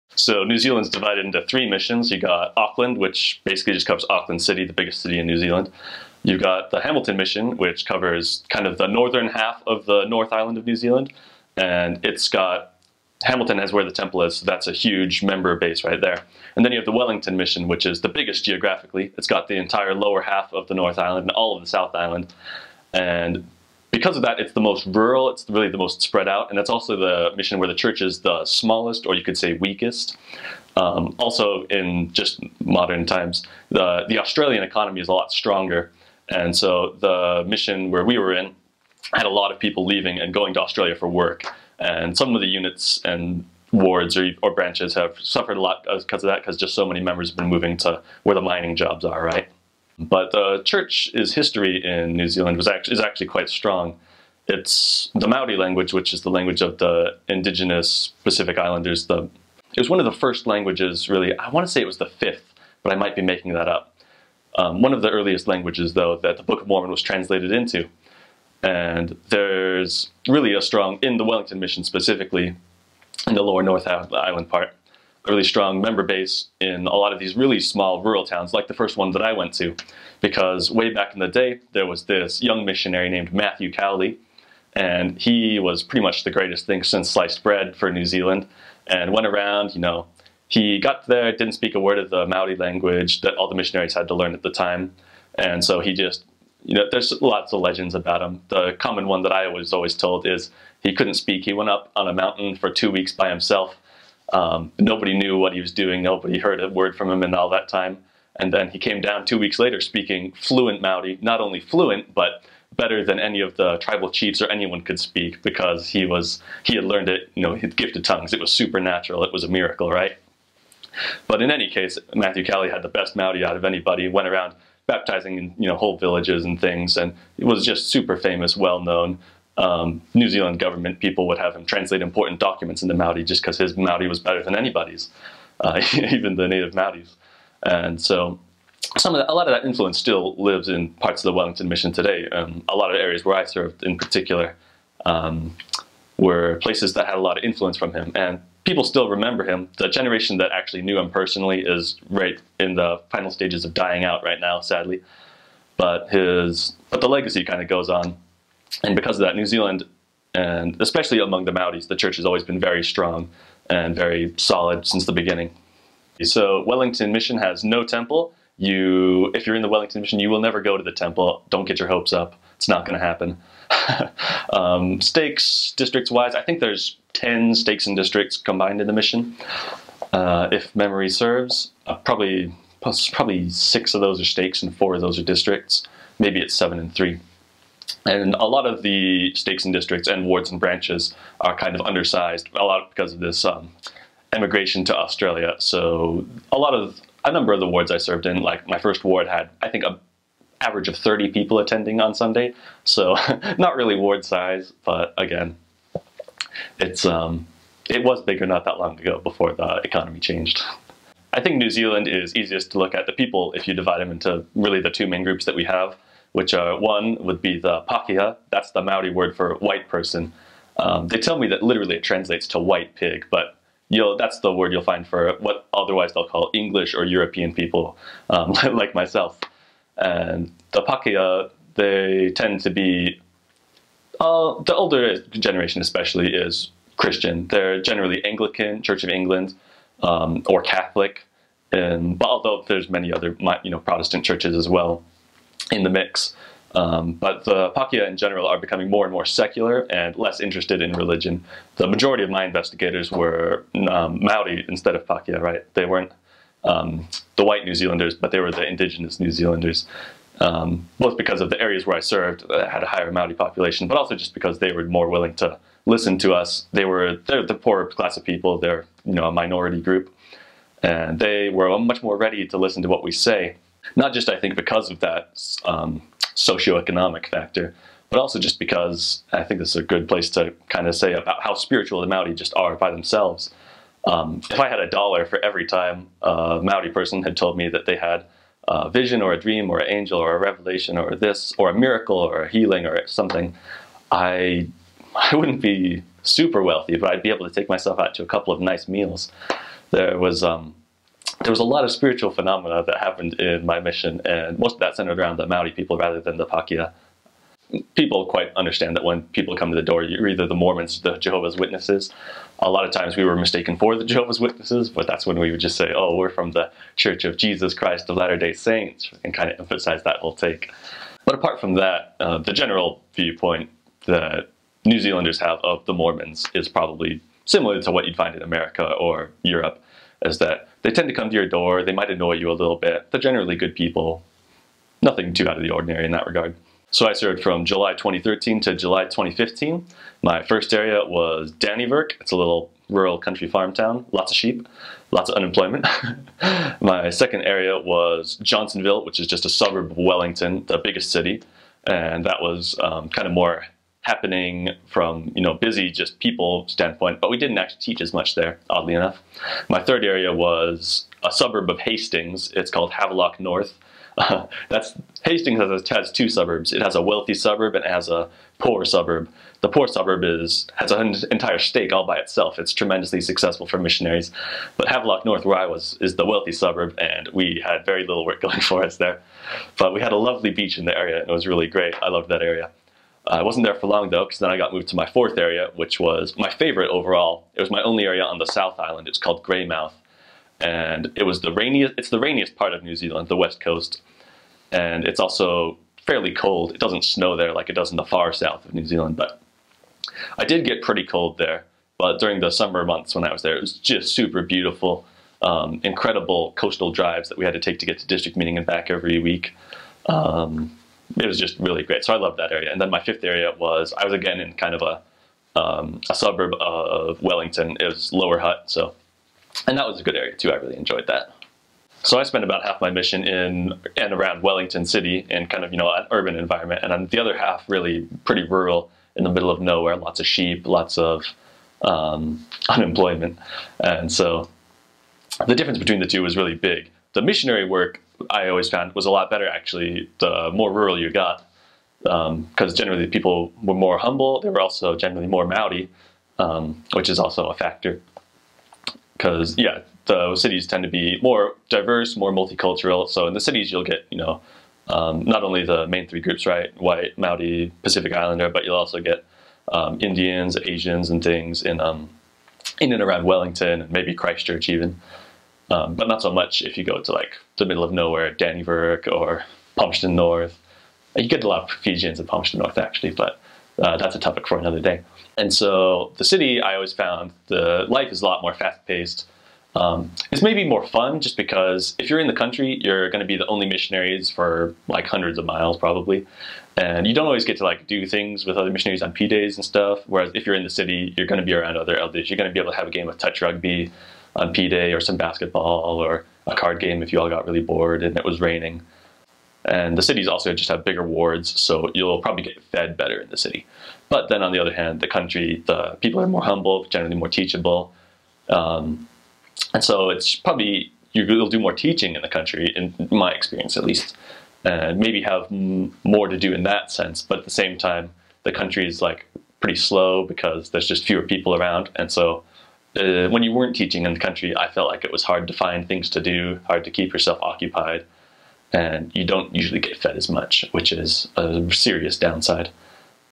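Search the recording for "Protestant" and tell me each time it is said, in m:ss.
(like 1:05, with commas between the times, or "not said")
4:03.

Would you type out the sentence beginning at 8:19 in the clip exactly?
And the cities also just have bigger wards, so you'll probably get fed better in the city.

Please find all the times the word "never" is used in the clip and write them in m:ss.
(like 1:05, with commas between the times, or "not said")
2:50.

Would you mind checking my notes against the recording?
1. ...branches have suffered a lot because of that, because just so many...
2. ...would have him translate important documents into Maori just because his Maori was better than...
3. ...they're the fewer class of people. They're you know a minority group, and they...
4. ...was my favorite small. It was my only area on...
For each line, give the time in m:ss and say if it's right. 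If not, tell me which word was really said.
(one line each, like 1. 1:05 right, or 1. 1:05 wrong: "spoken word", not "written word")
1. 0:44 right
2. 2:11 right
3. 4:27 wrong: "poorer", not "fewer"
4. 6:25 wrong: "overall", not "small".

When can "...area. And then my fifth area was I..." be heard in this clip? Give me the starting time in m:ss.
6:52.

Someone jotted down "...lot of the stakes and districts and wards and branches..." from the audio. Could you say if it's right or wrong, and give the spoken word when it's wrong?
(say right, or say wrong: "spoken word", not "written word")
right.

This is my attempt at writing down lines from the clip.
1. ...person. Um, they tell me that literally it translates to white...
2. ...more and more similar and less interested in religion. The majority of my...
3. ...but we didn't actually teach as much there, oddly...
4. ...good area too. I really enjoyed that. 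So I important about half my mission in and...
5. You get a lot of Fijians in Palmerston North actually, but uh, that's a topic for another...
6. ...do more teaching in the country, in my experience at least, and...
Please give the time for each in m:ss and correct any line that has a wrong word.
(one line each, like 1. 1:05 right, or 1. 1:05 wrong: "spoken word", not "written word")
1. 3:39 right
2. 4:08 wrong: "secular", not "similar"
3. 5:57 right
4. 7:00 wrong: "spent", not "important"
5. 7:51 right
6. 8:31 right.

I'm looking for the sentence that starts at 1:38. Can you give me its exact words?
The common one that I was always told is he couldn't speak.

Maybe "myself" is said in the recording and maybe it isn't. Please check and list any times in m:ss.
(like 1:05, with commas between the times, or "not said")
3:48, 4:57.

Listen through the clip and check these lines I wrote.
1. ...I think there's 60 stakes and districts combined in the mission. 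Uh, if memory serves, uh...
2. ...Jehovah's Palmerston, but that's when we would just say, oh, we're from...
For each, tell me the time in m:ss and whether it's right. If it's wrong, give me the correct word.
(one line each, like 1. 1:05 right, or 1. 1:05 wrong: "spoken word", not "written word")
1. 2:56 wrong: "10", not "60"
2. 5:14 wrong: "Witnesses", not "Palmerston".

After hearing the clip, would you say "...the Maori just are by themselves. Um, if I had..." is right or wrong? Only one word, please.
right.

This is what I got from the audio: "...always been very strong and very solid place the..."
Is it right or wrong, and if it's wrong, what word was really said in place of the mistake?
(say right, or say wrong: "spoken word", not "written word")
wrong: "since", not "place".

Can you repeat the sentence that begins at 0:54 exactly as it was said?
It's the Maori language, which is the language of the indigenous Pacific Islanders.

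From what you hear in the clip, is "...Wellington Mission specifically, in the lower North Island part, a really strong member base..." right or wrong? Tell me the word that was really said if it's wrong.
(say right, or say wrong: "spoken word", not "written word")
right.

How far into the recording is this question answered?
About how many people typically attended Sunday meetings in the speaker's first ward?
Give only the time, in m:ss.
3:20.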